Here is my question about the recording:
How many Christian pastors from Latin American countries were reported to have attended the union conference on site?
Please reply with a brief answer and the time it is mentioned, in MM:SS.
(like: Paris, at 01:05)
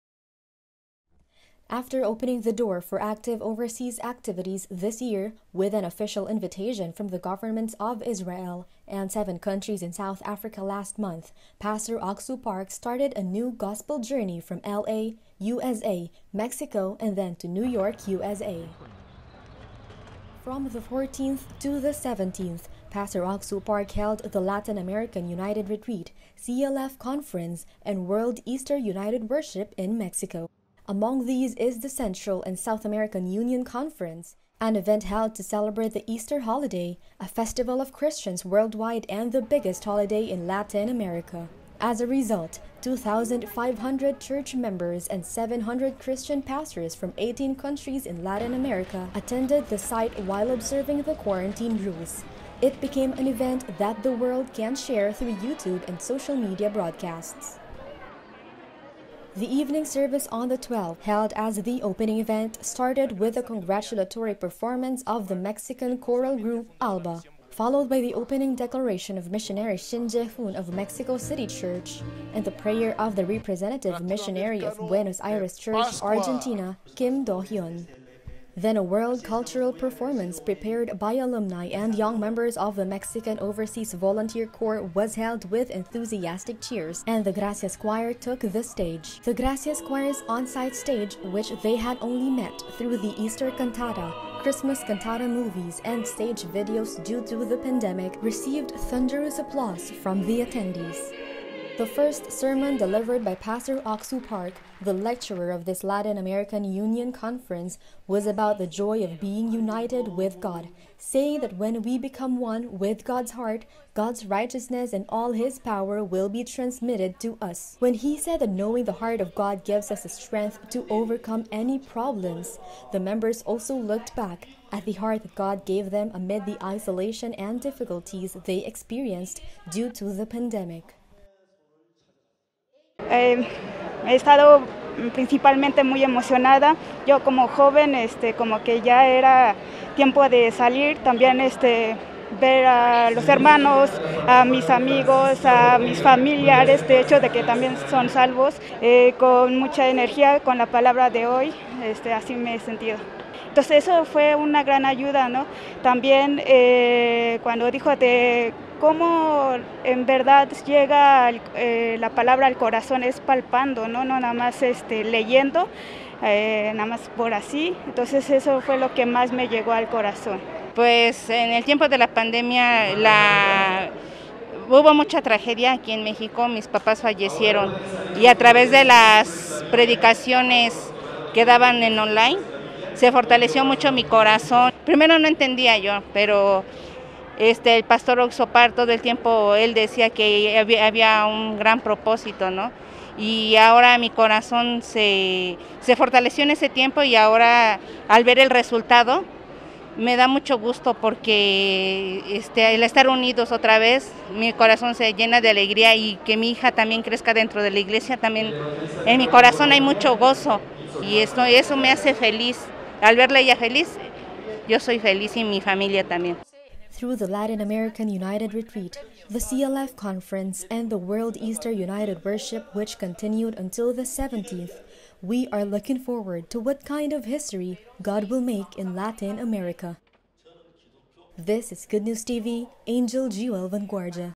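700, at 00:45.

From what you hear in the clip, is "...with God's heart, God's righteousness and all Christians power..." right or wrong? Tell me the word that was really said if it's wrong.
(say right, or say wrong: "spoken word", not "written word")
wrong: "His", not "Christians".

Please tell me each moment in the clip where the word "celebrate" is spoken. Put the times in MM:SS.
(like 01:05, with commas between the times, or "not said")
00:35.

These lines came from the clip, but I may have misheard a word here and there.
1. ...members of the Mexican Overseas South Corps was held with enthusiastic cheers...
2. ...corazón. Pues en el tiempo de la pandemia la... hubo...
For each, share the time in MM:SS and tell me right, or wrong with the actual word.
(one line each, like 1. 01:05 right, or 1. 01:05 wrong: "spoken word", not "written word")
1. 01:22 wrong: "Volunteer", not "South"
2. 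02:49 right.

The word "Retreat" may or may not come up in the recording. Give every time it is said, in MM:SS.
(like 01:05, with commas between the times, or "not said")
00:25, 03:38.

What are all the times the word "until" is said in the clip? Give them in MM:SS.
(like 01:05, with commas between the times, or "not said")
03:43.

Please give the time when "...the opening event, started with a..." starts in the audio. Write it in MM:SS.
01:01.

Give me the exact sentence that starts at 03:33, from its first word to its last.
Al verla ella feliz, yo soy feliz y mi familia también.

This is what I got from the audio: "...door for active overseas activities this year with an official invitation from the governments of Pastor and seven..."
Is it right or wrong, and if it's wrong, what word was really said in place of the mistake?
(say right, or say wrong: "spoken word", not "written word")
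wrong: "Israel", not "Pastor".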